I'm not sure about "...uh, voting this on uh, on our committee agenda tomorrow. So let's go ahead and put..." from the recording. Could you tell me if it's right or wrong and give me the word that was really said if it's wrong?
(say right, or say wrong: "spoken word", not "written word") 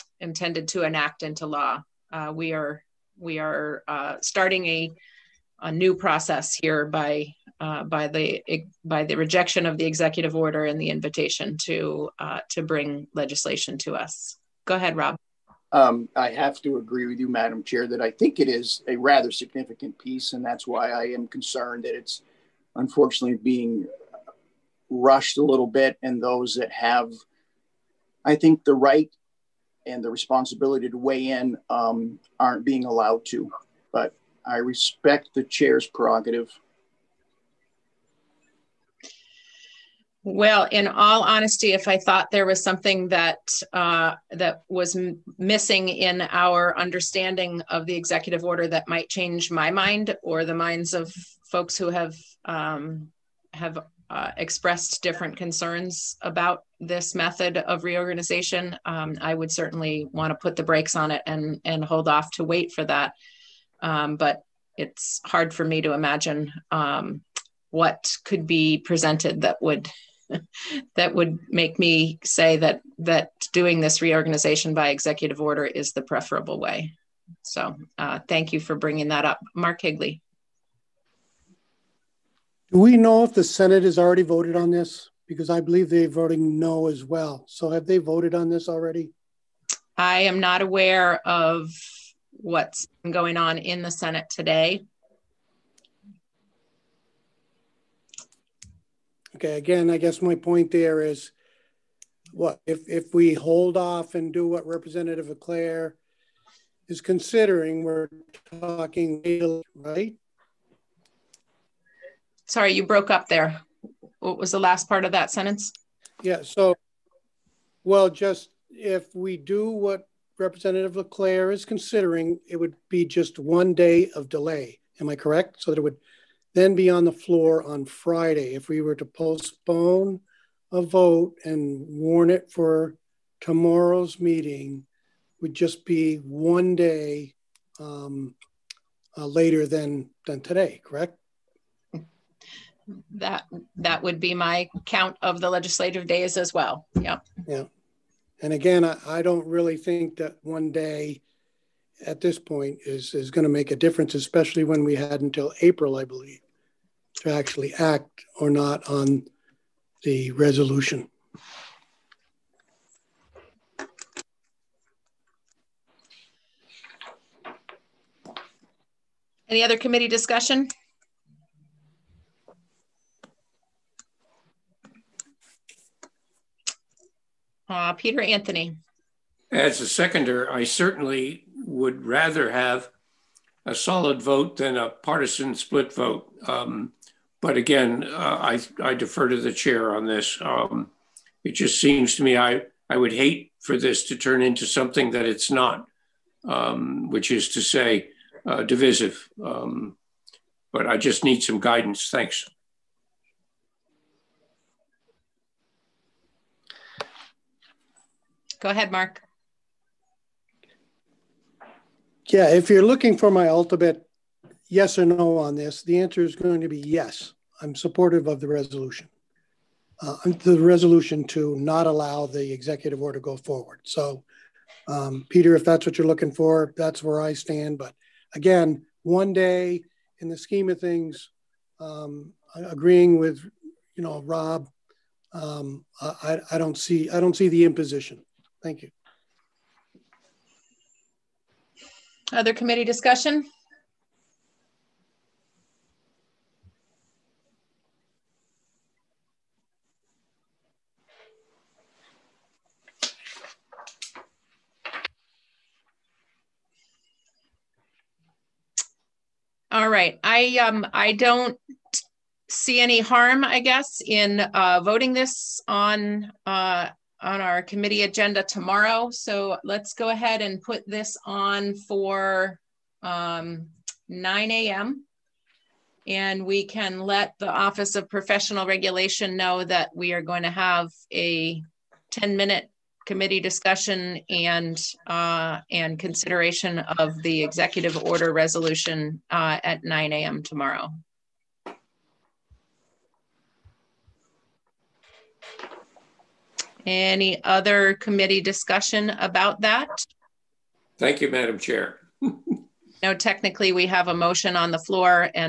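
right.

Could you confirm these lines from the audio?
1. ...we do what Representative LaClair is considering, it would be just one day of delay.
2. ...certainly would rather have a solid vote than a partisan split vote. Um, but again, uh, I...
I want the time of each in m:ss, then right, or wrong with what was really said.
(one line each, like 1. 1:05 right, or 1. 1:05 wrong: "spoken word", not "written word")
1. 1:59 right
2. 3:00 right.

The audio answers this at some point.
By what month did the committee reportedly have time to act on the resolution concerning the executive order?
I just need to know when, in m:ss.
2:35.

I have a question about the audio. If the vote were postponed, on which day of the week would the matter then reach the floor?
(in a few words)
Friday.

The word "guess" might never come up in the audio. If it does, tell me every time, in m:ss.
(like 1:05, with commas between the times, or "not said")
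1:39, 4:23.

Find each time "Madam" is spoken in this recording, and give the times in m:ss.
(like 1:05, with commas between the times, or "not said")
0:17, 5:01.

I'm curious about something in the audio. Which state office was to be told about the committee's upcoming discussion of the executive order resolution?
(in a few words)
Office of Professional Regulation.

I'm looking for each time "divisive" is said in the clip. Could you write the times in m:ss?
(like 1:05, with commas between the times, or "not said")
3:18.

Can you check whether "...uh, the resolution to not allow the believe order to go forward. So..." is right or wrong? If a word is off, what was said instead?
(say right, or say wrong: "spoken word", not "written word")
wrong: "executive", not "believe".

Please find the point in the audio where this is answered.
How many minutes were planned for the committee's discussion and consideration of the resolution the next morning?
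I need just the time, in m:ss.
4:42.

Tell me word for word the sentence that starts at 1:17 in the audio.
So uh, thank you for bringing that up, Mark Higley.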